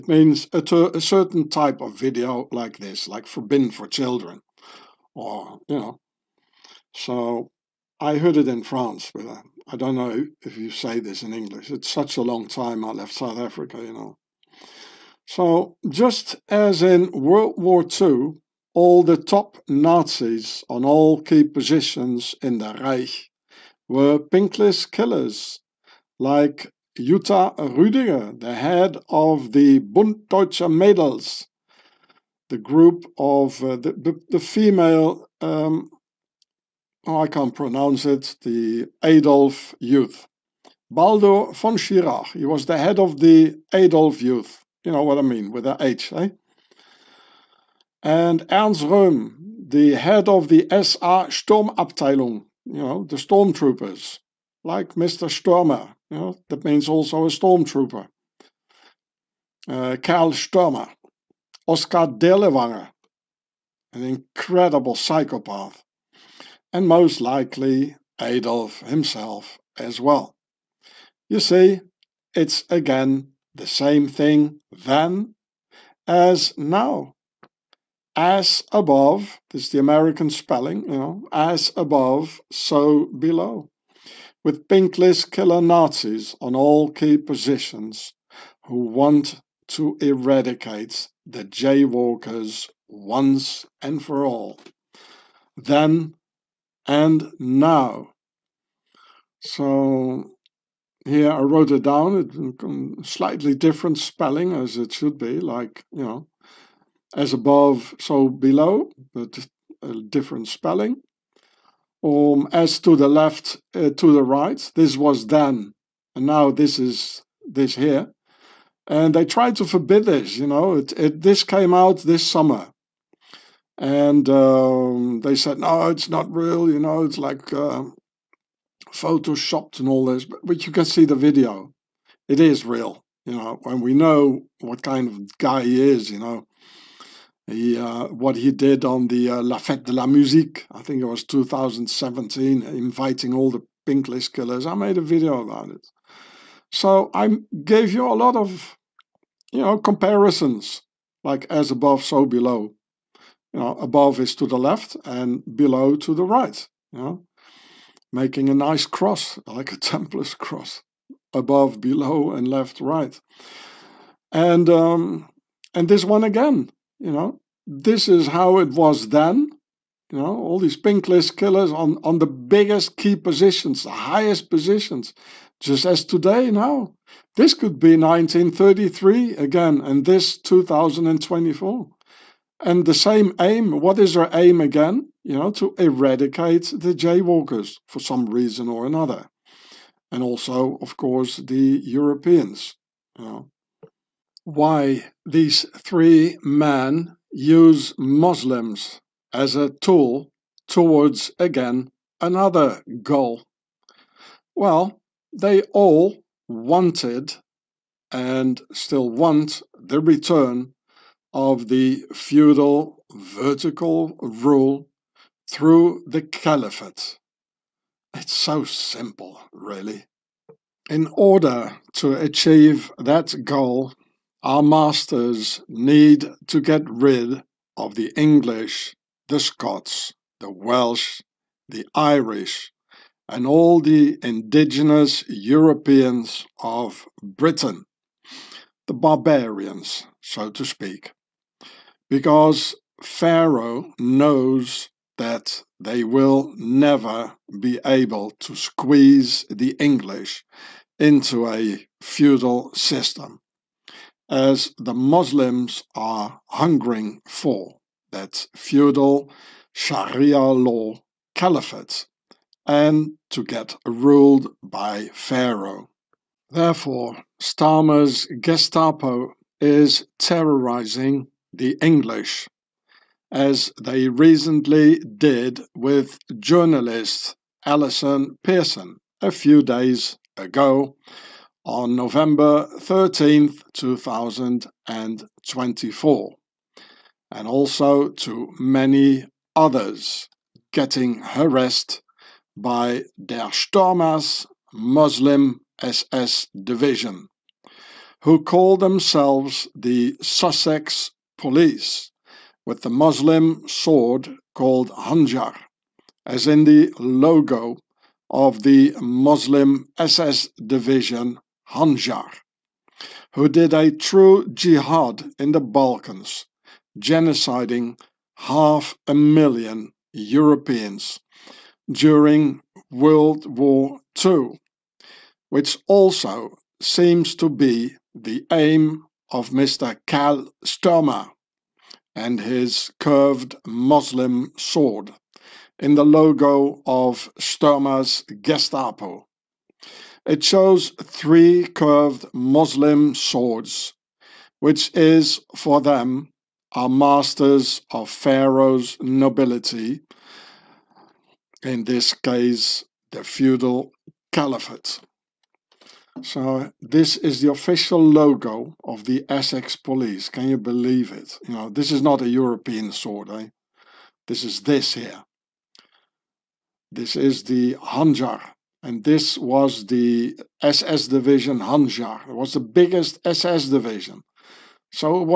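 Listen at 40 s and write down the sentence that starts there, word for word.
Baldur von Schirach, he was the head of the Adolf Youth.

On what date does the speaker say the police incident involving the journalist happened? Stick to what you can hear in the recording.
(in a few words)
November 13, 2024.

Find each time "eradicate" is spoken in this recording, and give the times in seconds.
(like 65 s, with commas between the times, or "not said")
90 s, 185 s.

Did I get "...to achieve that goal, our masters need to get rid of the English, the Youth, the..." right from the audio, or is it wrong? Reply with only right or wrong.
wrong.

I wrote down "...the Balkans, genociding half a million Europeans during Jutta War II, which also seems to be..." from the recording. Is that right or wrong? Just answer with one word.
wrong.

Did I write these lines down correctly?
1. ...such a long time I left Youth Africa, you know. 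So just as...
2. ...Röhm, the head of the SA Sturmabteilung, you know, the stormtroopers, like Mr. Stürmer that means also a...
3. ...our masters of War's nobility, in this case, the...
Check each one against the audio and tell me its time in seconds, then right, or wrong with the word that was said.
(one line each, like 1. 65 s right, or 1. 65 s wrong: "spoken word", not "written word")
1. 11 s wrong: "South", not "Youth"
2. 48 s right
3. 346 s wrong: "Pharaoh", not "War".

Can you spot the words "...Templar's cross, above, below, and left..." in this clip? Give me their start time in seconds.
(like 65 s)
159 s.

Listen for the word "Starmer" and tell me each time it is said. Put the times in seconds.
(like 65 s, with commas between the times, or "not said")
267 s.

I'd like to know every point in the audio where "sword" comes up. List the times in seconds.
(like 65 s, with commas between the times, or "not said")
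303 s, 334 s, 343 s, 362 s.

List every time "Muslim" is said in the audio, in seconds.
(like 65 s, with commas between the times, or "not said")
197 s, 254 s, 294 s, 302 s, 309 s, 333 s, 342 s.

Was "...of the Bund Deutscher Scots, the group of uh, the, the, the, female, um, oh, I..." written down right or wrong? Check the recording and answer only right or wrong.
wrong.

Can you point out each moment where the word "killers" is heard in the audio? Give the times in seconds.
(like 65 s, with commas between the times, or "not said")
24 s, 85 s, 144 s, 171 s.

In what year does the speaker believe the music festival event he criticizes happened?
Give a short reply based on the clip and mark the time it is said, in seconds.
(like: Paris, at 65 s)
2017, at 141 s.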